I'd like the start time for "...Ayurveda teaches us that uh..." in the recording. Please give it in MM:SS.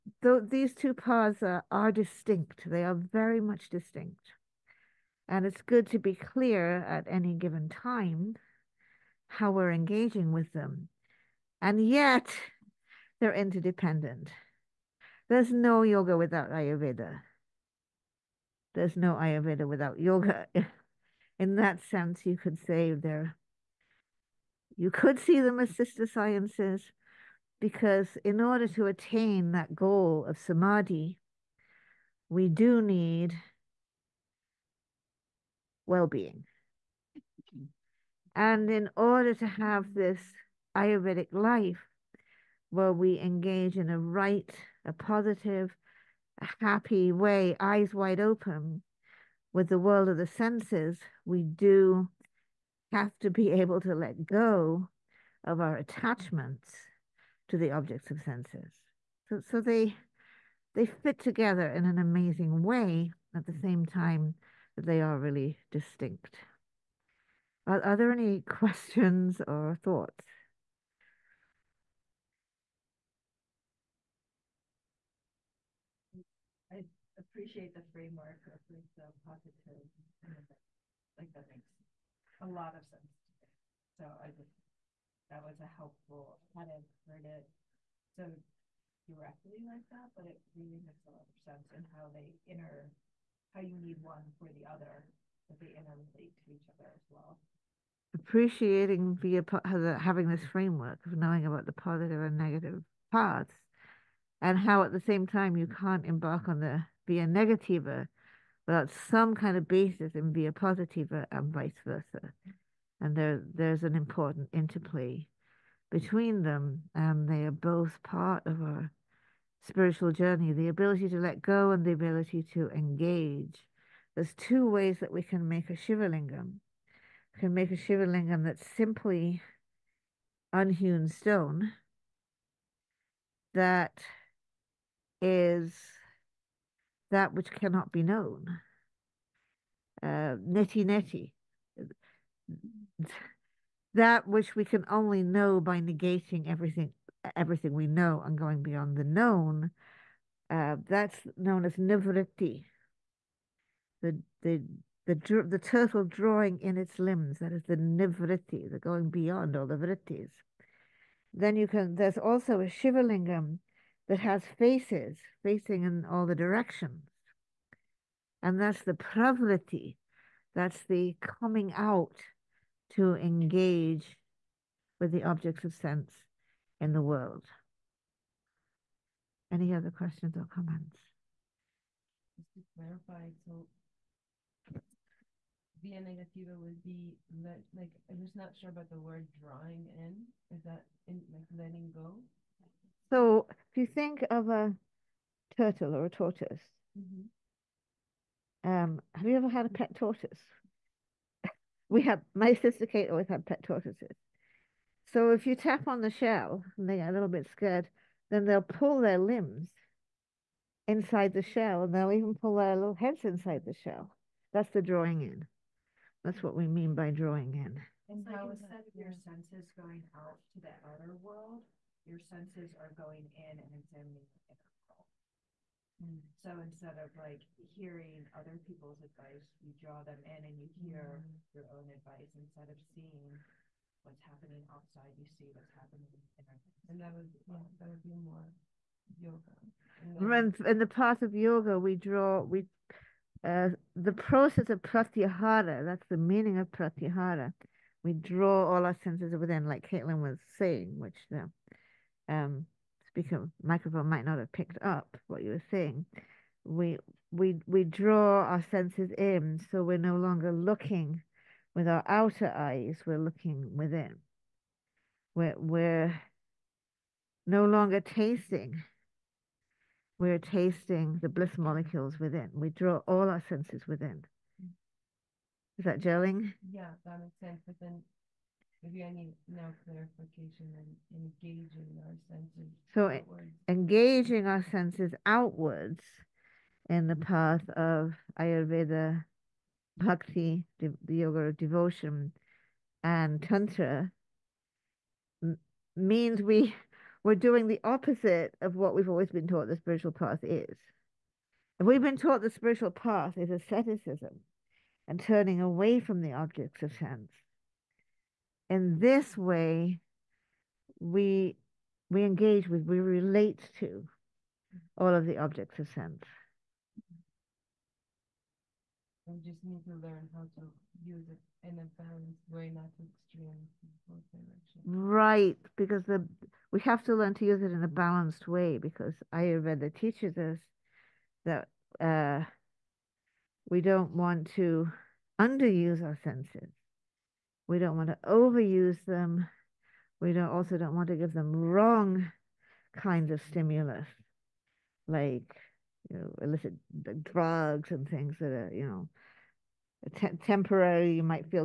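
05:29.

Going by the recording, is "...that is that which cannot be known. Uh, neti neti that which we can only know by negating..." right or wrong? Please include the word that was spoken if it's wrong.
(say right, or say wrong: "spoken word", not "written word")
right.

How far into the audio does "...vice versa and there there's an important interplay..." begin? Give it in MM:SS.
01:51.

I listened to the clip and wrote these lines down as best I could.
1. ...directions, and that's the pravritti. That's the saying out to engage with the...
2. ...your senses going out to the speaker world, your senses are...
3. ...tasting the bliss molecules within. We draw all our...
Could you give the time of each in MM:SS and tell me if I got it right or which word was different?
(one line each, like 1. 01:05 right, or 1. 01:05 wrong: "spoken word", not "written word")
1. 02:46 wrong: "coming", not "saying"
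2. 03:38 wrong: "outer", not "speaker"
3. 04:30 right.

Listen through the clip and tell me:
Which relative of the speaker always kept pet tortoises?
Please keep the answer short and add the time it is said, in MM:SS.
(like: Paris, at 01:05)
Kate, at 03:22.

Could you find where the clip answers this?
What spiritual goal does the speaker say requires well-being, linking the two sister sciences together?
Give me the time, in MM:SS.
00:30.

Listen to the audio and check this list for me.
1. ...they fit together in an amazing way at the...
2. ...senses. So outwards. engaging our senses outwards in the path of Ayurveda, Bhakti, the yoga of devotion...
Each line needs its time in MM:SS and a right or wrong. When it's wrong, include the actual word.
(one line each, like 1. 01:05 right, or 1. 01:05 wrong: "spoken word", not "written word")
1. 01:00 right
2. 04:42 right.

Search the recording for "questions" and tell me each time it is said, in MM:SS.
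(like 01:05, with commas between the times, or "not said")
01:08, 02:59.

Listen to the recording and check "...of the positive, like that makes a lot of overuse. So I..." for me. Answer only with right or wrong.
wrong.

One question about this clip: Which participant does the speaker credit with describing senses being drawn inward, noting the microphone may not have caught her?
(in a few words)
Caitlin.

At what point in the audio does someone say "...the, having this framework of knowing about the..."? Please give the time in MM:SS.
01:39.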